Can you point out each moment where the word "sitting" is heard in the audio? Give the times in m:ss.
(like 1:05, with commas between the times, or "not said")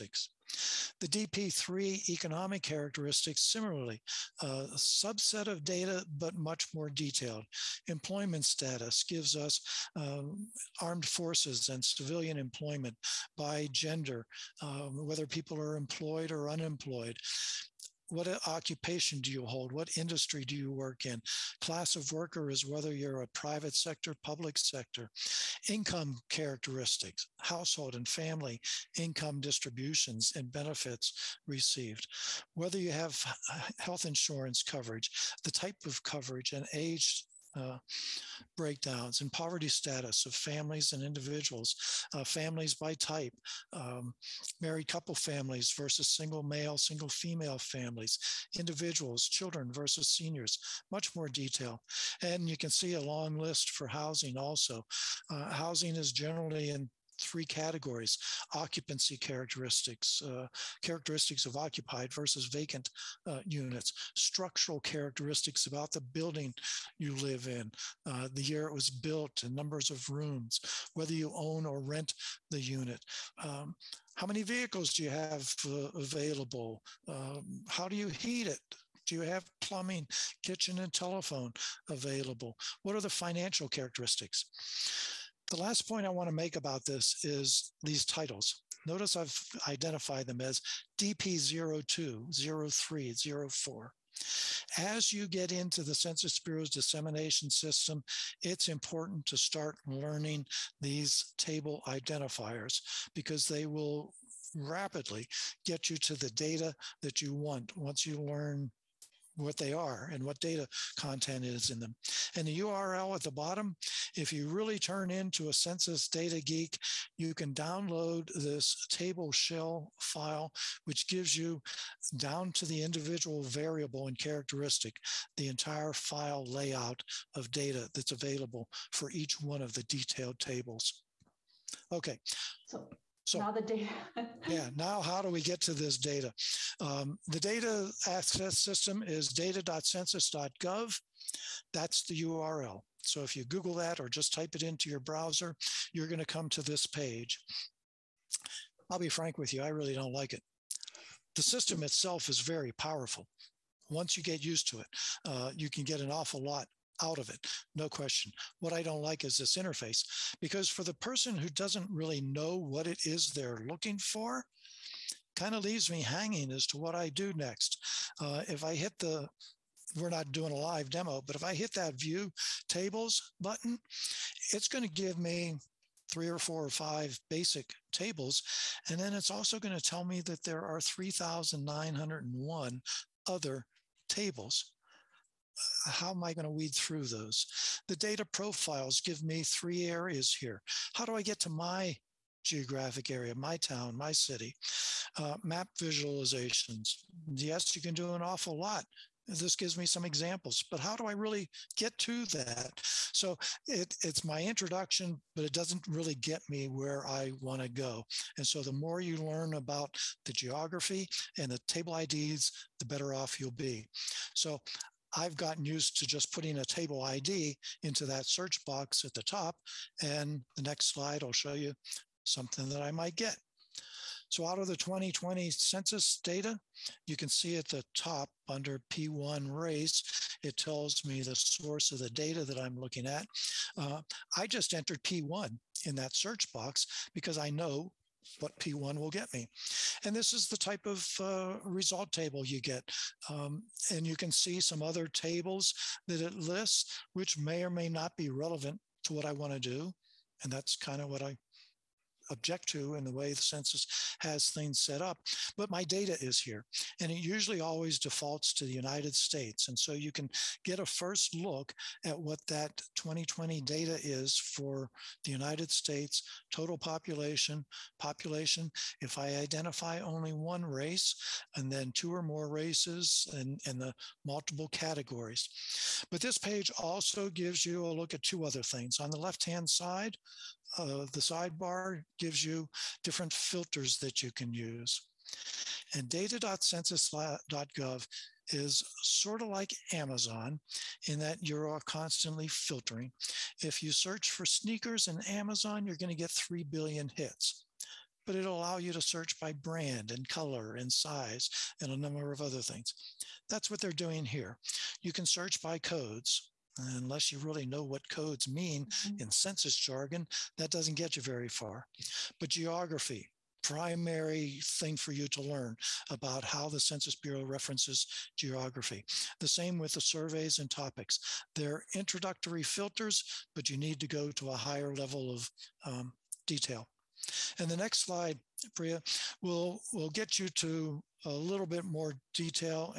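not said.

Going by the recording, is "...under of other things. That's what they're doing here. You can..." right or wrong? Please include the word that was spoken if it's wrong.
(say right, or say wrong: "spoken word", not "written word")
wrong: "number", not "under".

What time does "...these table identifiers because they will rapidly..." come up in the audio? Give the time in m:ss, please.
1:40.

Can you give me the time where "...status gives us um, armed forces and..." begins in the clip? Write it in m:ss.
0:08.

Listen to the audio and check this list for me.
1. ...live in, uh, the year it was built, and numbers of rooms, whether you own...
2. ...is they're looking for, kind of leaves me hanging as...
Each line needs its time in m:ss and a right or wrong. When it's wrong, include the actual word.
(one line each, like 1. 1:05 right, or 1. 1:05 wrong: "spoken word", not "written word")
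1. 1:07 right
2. 2:43 right.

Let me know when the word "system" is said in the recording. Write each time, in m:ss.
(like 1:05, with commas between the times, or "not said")
1:37, 2:18, 2:31.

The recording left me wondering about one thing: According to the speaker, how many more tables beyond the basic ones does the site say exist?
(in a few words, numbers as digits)
3,901.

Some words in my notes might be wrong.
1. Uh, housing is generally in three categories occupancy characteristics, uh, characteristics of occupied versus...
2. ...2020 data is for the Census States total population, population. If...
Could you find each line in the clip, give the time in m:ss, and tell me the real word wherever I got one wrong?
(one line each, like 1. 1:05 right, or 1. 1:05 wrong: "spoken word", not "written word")
1. 0:55 right
2. 4:22 wrong: "United", not "Census".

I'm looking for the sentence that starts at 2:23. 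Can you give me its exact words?
So if you Google that or just type it into your browser, you're going to come to this page.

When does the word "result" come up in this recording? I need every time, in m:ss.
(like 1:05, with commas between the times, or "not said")
4:01.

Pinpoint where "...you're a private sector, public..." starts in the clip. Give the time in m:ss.
0:22.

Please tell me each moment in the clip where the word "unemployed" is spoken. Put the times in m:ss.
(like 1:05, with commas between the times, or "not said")
0:16.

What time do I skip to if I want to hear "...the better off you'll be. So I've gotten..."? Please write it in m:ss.
3:32.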